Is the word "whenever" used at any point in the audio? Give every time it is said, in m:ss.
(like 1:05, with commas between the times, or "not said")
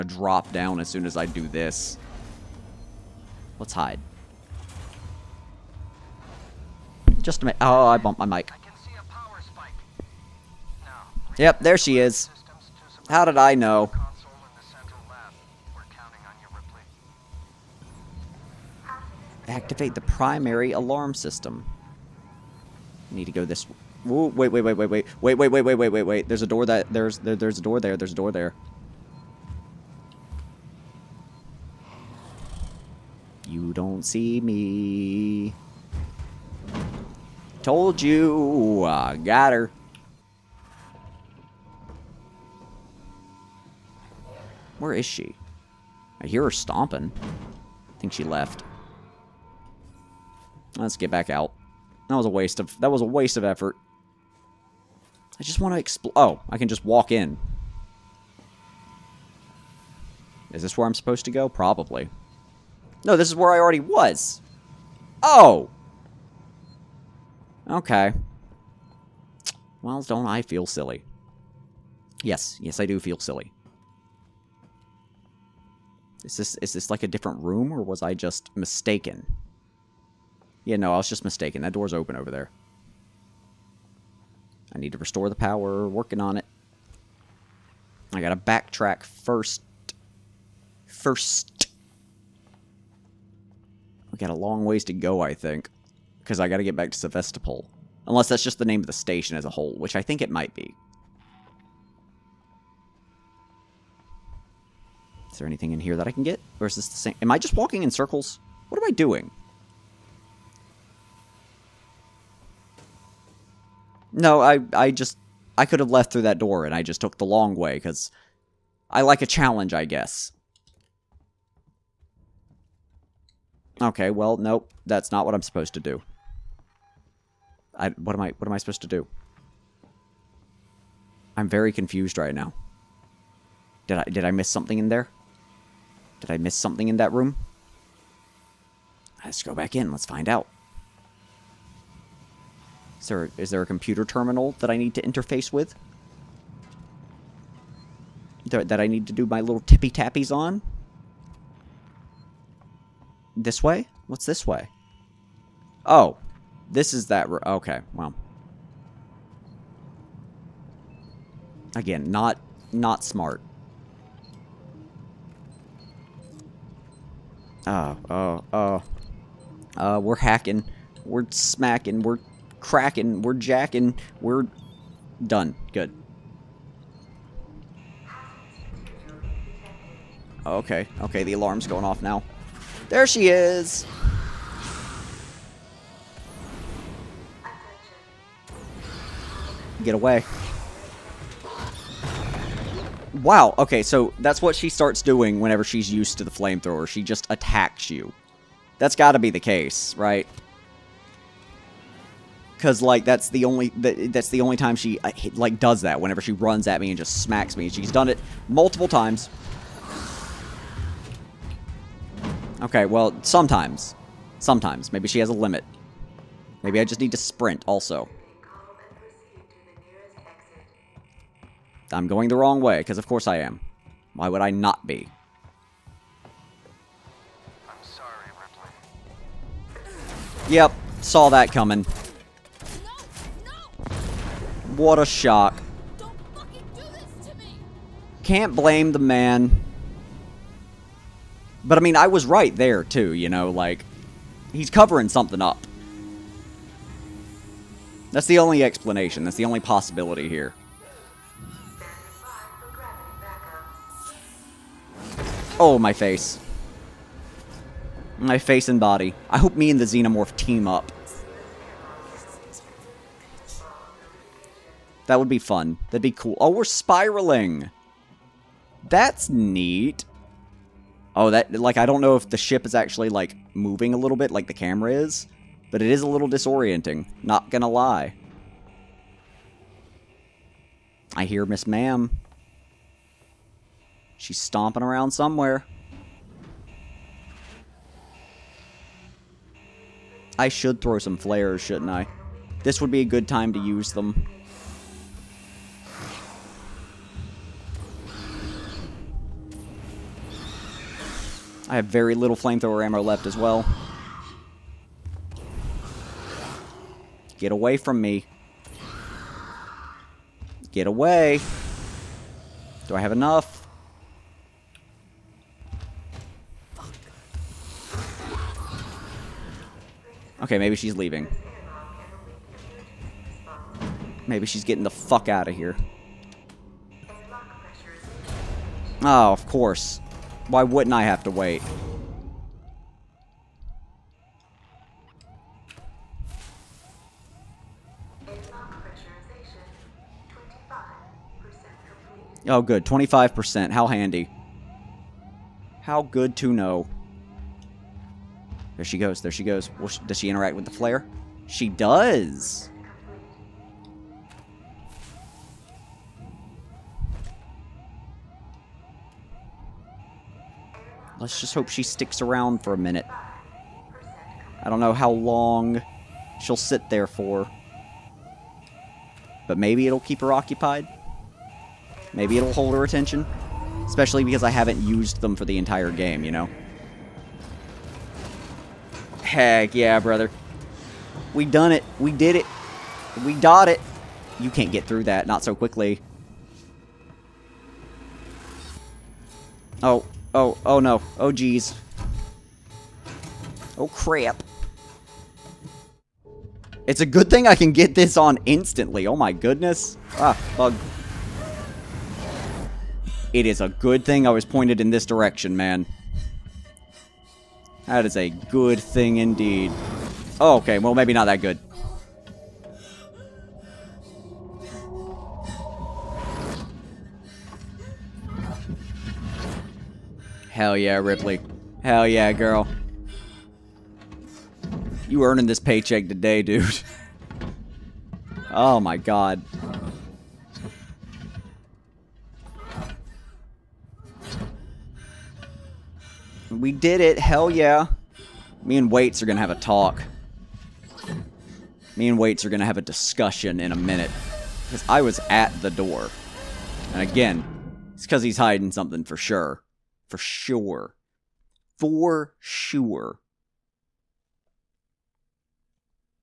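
3:15, 3:26.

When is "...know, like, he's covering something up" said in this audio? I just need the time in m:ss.
4:03.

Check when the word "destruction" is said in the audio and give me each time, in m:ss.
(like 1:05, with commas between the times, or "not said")
not said.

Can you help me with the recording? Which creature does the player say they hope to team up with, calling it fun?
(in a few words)
Xenomorph.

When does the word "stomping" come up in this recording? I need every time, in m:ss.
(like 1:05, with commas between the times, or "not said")
0:46, 4:44.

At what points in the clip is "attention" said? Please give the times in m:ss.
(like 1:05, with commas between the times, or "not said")
6:12.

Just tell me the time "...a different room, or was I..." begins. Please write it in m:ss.
1:17.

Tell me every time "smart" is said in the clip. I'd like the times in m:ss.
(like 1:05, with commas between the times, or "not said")
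2:43.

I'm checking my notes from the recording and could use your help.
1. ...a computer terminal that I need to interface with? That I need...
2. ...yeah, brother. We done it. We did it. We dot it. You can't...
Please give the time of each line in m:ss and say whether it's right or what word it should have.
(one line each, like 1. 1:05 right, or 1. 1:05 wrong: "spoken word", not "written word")
1. 2:23 right
2. 6:19 right.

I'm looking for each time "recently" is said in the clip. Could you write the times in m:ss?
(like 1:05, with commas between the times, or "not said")
not said.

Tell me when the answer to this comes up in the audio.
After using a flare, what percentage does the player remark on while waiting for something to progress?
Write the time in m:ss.
5:42.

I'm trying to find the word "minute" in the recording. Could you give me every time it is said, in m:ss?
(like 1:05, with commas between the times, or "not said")
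0:07, 6:02, 7:23.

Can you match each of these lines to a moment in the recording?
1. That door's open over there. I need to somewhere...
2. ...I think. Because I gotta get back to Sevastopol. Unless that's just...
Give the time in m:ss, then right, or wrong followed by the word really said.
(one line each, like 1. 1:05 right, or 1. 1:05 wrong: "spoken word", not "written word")
1. 1:21 wrong: "restore", not "somewhere"
2. 1:35 right.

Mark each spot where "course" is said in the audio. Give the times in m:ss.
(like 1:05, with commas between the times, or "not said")
3:43, 5:29.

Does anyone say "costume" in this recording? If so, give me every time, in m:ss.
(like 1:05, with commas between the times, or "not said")
not said.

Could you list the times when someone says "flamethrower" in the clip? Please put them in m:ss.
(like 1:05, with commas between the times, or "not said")
3:16, 5:02.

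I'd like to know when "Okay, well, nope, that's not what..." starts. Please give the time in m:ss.
2:03.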